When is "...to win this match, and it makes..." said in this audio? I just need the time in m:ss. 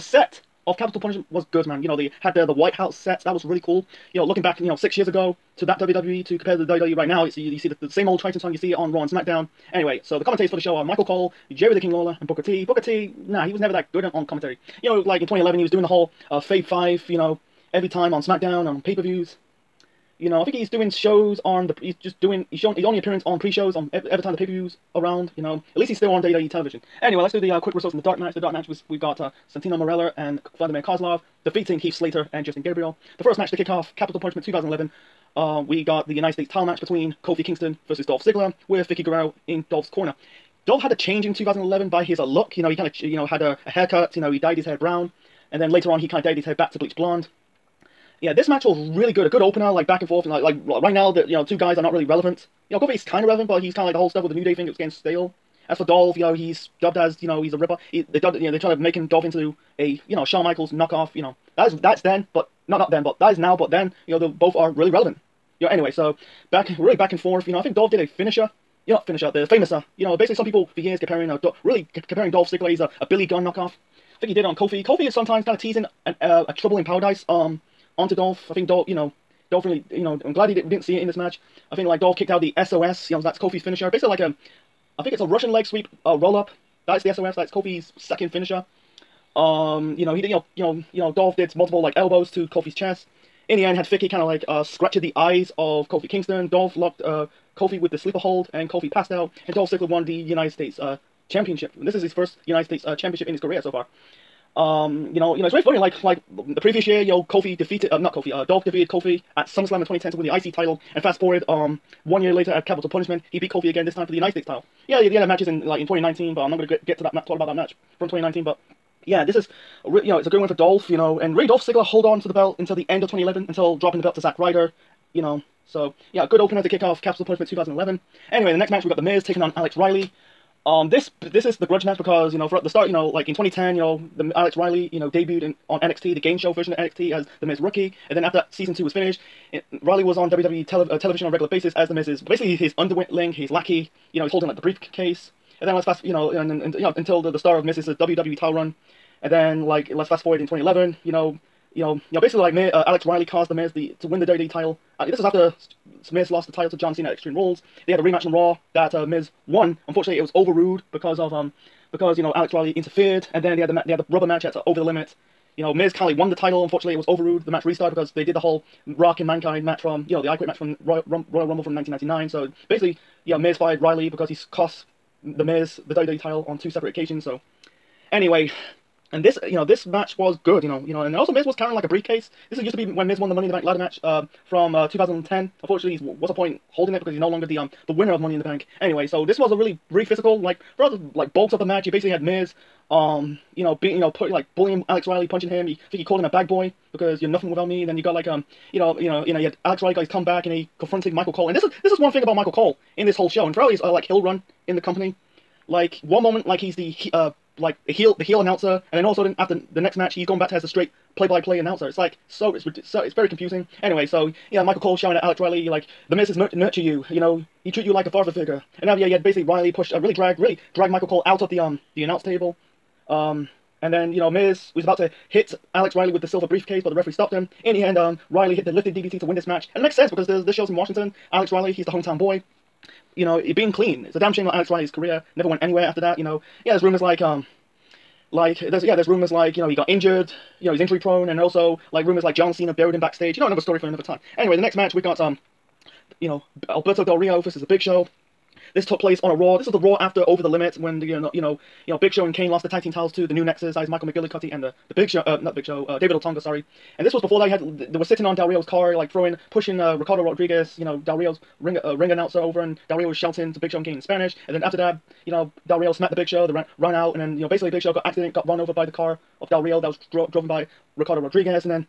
3:49.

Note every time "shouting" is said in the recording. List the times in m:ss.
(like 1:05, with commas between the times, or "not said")
3:34, 4:23.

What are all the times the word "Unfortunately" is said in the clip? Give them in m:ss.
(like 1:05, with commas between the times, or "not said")
2:39, 2:46, 3:05.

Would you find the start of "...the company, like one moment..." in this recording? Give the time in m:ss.
3:24.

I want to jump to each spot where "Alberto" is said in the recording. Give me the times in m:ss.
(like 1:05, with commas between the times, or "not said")
4:06.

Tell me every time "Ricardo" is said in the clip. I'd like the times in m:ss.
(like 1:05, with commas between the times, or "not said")
4:19, 4:30.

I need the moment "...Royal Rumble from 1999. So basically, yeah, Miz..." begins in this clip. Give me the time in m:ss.
2:51.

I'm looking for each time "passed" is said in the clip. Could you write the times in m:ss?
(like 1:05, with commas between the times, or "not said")
1:38.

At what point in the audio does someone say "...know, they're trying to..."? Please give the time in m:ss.
0:58.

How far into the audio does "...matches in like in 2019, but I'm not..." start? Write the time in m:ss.
1:55.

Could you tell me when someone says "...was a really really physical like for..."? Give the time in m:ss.
3:09.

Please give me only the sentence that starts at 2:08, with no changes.
Anyway, in the next match we got The Miz taking on Alex Riley.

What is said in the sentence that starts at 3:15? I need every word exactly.
He, I think he called him a bag boy because you're nothing without me.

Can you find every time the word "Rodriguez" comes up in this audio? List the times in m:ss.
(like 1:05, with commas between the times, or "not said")
4:20, 4:31.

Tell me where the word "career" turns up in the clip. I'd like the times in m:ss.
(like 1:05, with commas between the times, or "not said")
1:43, 3:54.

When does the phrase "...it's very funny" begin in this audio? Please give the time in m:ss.
1:45.